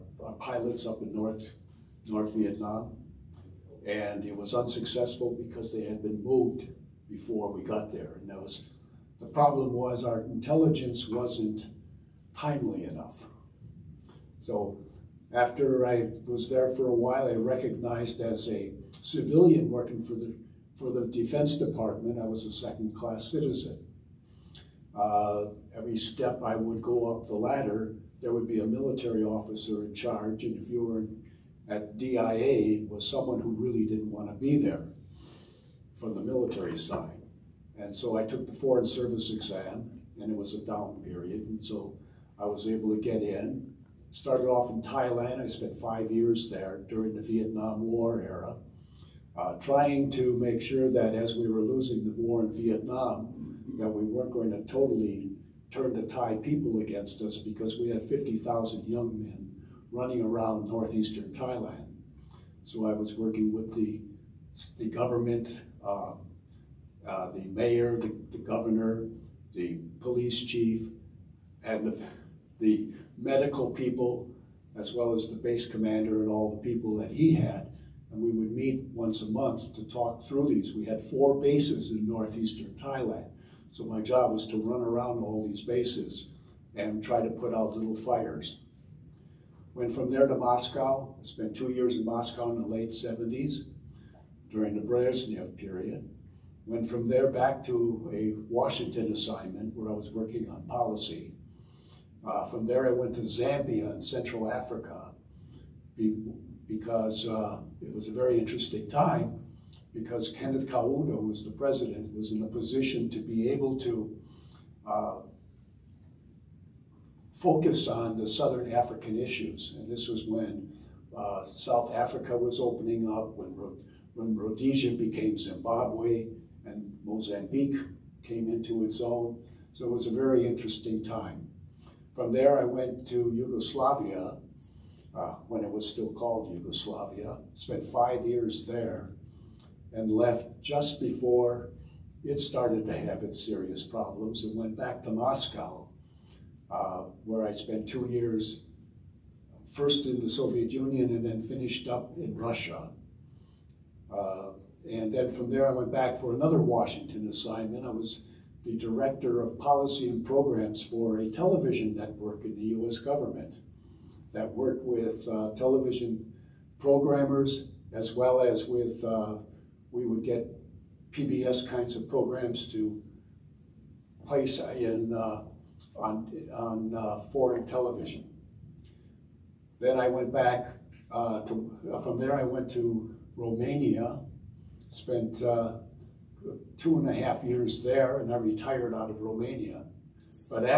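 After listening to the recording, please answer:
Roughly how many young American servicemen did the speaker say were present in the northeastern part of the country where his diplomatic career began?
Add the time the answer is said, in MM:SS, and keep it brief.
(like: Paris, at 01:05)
50,000, at 00:58.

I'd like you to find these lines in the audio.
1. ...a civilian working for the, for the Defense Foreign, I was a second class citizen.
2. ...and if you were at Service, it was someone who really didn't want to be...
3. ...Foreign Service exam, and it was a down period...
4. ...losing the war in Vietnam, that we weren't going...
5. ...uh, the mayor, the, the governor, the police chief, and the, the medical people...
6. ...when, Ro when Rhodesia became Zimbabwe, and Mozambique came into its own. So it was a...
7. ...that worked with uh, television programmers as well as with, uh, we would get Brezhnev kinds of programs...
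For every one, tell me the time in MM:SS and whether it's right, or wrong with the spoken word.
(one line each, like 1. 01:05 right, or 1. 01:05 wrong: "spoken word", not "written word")
1. 00:18 wrong: "Department", not "Foreign"
2. 00:30 wrong: "DIA", not "Service"
3. 00:38 right
4. 00:51 right
5. 01:07 right
6. 02:03 right
7. 02:44 wrong: "PBS", not "Brezhnev".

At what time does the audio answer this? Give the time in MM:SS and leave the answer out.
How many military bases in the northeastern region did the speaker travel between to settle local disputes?
01:21.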